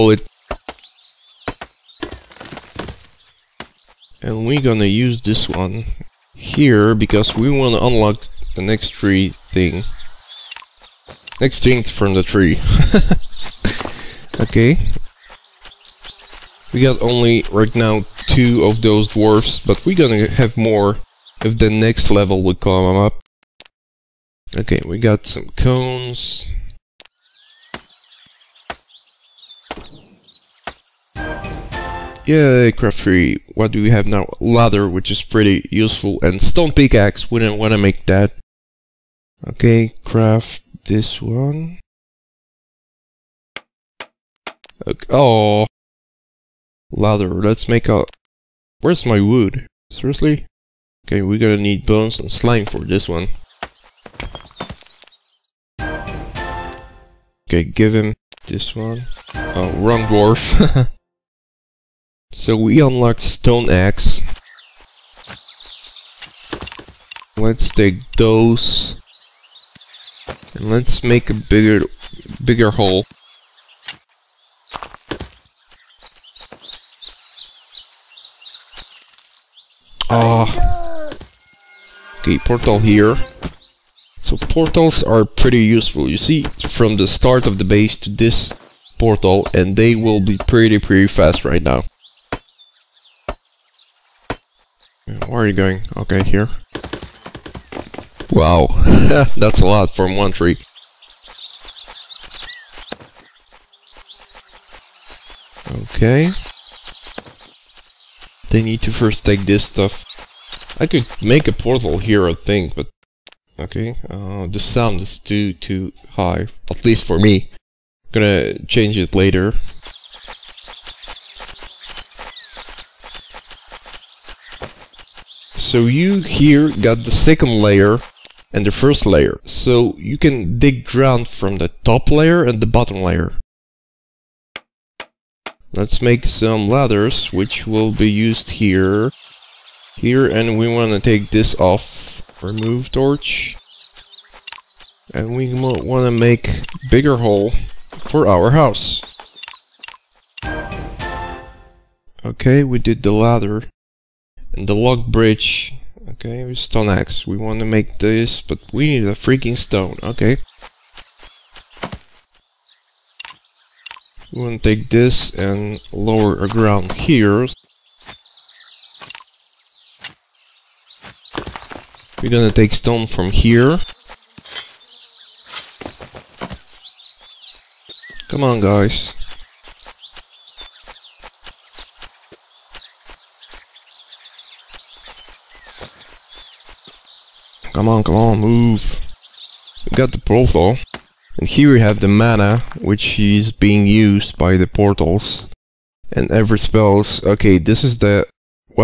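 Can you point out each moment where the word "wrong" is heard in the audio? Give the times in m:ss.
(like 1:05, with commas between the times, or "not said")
0:59.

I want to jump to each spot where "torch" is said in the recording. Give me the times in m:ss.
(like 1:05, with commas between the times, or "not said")
2:22.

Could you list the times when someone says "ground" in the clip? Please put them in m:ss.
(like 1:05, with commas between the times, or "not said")
2:10, 2:46.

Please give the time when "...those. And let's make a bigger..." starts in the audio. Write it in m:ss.
1:08.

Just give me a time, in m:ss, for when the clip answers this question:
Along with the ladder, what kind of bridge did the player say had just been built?
2:34.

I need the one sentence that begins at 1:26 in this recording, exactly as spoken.
You see from the start of the base to this portal and they will be pretty pretty fast right now.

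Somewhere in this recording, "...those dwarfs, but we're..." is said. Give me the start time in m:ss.
0:18.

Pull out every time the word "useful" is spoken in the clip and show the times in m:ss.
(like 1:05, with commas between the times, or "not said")
0:35, 1:25.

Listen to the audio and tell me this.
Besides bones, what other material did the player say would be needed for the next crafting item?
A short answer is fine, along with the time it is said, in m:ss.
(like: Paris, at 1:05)
slime, at 0:52.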